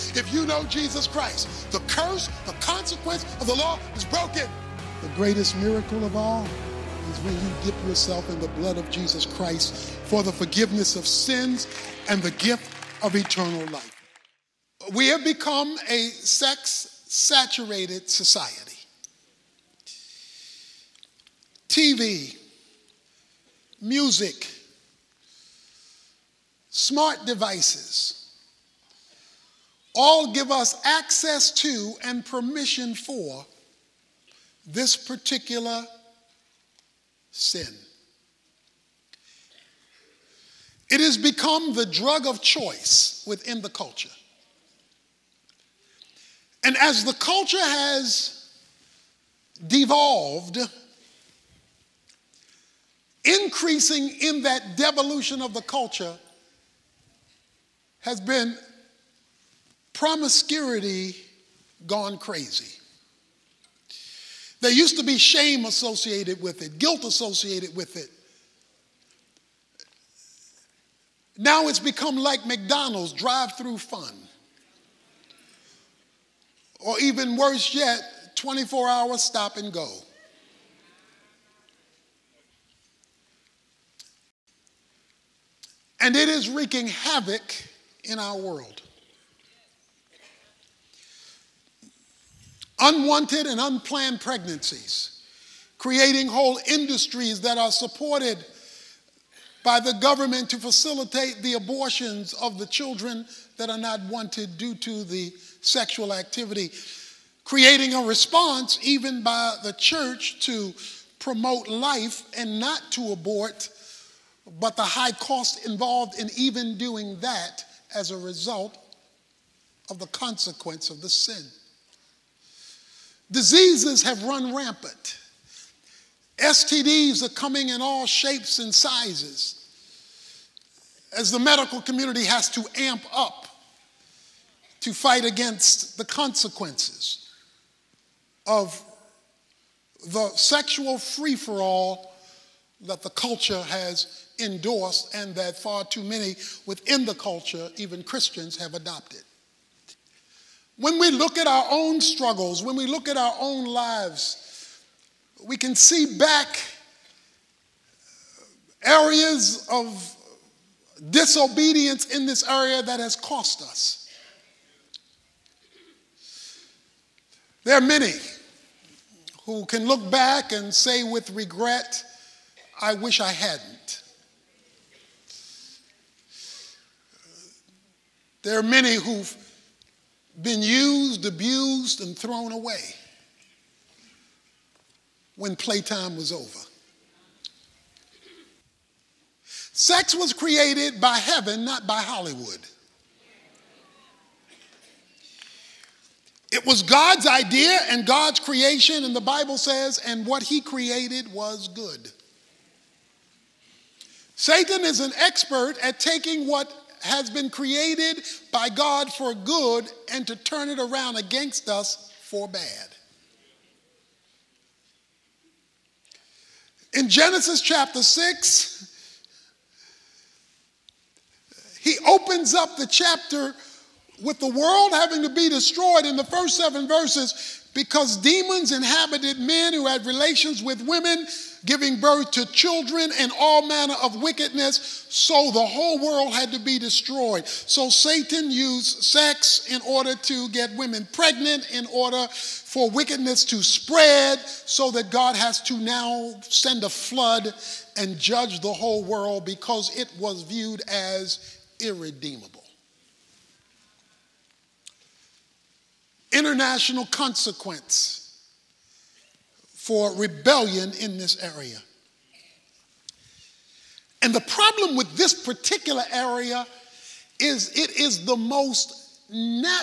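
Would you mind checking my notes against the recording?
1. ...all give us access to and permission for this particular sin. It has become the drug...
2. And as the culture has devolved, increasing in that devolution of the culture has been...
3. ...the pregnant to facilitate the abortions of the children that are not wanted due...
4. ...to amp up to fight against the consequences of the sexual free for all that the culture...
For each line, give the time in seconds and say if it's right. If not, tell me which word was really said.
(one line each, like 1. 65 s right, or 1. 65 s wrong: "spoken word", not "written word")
1. 29 s right
2. 46 s right
3. 99 s wrong: "government", not "pregnant"
4. 132 s right.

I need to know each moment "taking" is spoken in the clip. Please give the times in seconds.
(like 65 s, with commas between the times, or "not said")
205 s.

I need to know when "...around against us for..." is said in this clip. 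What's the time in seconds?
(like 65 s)
210 s.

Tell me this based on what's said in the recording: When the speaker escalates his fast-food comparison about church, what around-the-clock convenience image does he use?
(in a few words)
24 hour stop and go.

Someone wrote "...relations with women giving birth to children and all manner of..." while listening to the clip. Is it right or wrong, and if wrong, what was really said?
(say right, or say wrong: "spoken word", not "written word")
right.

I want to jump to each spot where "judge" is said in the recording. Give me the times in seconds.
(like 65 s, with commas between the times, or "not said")
248 s.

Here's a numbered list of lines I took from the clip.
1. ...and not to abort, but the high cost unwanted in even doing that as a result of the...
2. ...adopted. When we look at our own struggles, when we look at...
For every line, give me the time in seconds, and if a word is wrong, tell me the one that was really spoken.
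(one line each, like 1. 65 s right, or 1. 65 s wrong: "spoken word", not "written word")
1. 112 s wrong: "involved", not "unwanted"
2. 148 s right.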